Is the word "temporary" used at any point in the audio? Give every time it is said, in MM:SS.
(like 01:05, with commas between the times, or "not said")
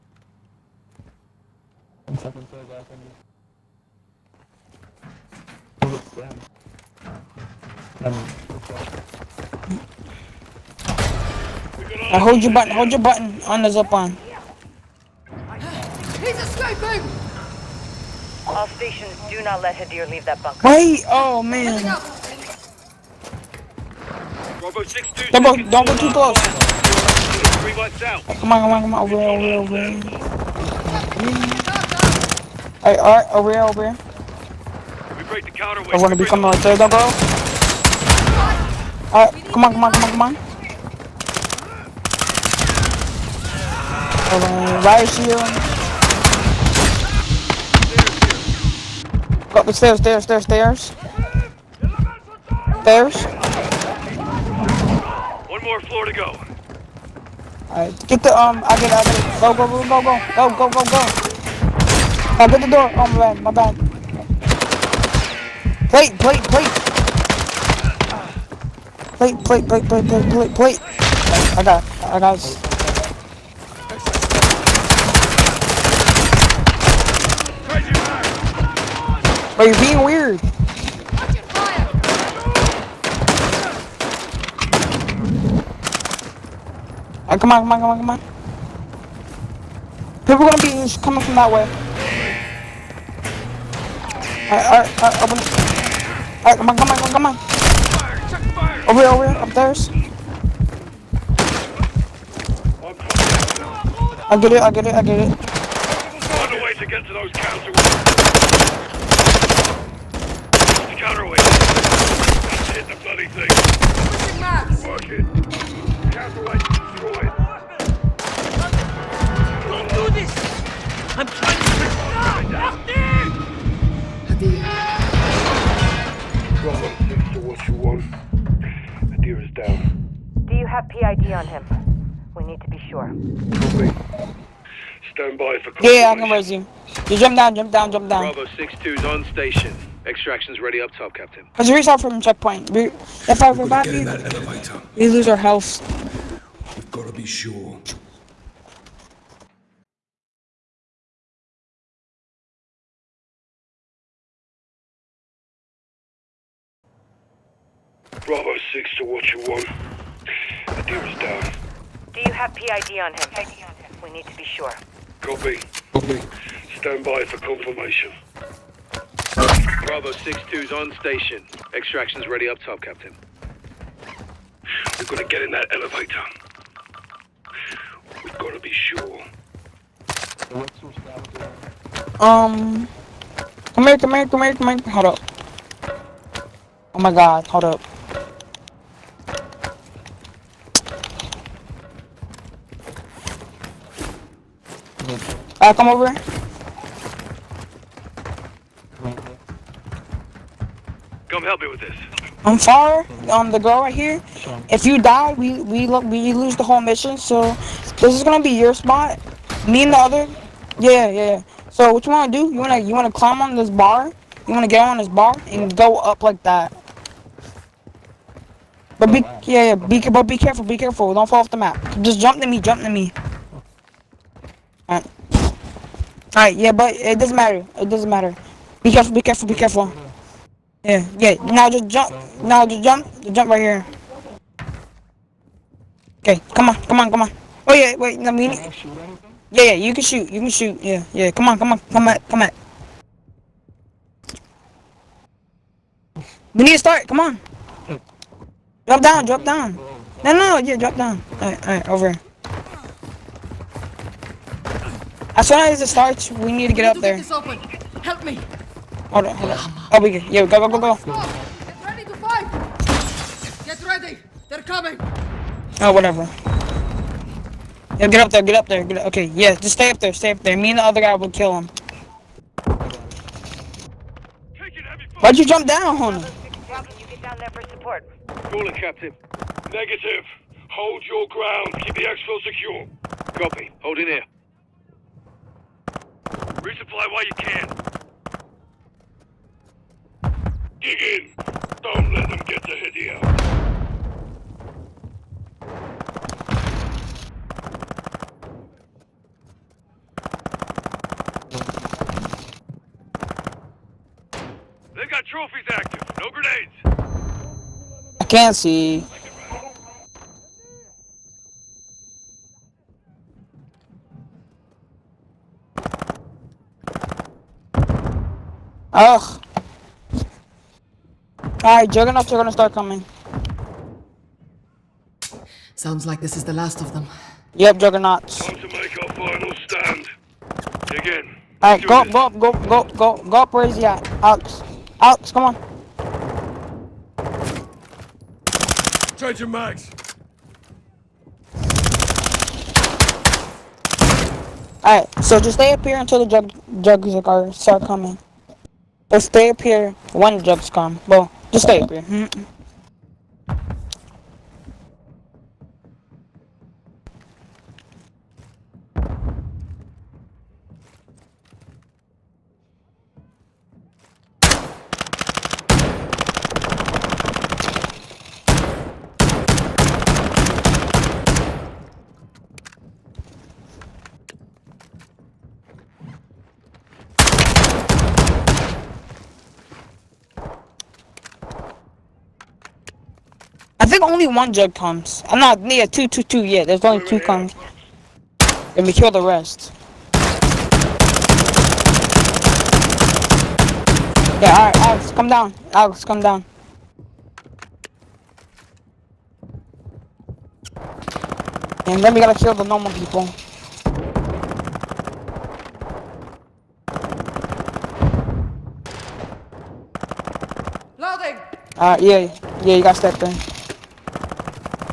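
not said.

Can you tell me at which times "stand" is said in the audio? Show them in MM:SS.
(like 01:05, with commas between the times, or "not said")
02:15, 02:46, 05:29.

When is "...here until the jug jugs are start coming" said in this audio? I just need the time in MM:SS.
05:45.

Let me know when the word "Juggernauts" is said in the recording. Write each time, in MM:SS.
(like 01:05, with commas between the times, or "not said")
05:21, 05:27.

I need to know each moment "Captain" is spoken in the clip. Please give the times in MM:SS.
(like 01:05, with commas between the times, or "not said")
02:21, 02:52, 04:38.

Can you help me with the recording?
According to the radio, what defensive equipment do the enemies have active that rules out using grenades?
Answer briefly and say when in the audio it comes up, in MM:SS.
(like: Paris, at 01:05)
trophies, at 05:05.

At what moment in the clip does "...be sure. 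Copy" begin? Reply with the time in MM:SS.
02:44.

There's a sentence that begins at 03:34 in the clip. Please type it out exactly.
You wanna get on this bar and go up like that.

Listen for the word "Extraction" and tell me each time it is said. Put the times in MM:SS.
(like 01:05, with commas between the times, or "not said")
02:20, 02:51.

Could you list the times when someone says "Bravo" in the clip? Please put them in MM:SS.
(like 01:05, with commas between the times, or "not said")
02:18, 02:38, 02:49.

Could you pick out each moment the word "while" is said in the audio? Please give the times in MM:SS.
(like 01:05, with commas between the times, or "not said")
04:47.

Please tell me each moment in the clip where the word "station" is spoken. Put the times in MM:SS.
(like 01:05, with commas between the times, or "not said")
00:18, 02:19, 02:50.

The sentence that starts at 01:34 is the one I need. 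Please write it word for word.
Alright, alright, alright, open Alright, come on, come on, come on, come on.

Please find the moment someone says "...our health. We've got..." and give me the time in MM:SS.
02:25.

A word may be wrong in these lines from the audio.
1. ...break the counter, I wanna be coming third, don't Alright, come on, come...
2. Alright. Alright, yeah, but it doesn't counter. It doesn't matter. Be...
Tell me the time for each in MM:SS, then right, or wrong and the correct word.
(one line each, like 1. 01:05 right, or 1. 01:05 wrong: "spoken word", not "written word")
1. 00:35 right
2. 03:44 wrong: "matter", not "counter".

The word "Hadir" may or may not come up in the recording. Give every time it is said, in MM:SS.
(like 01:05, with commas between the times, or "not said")
00:19, 02:40.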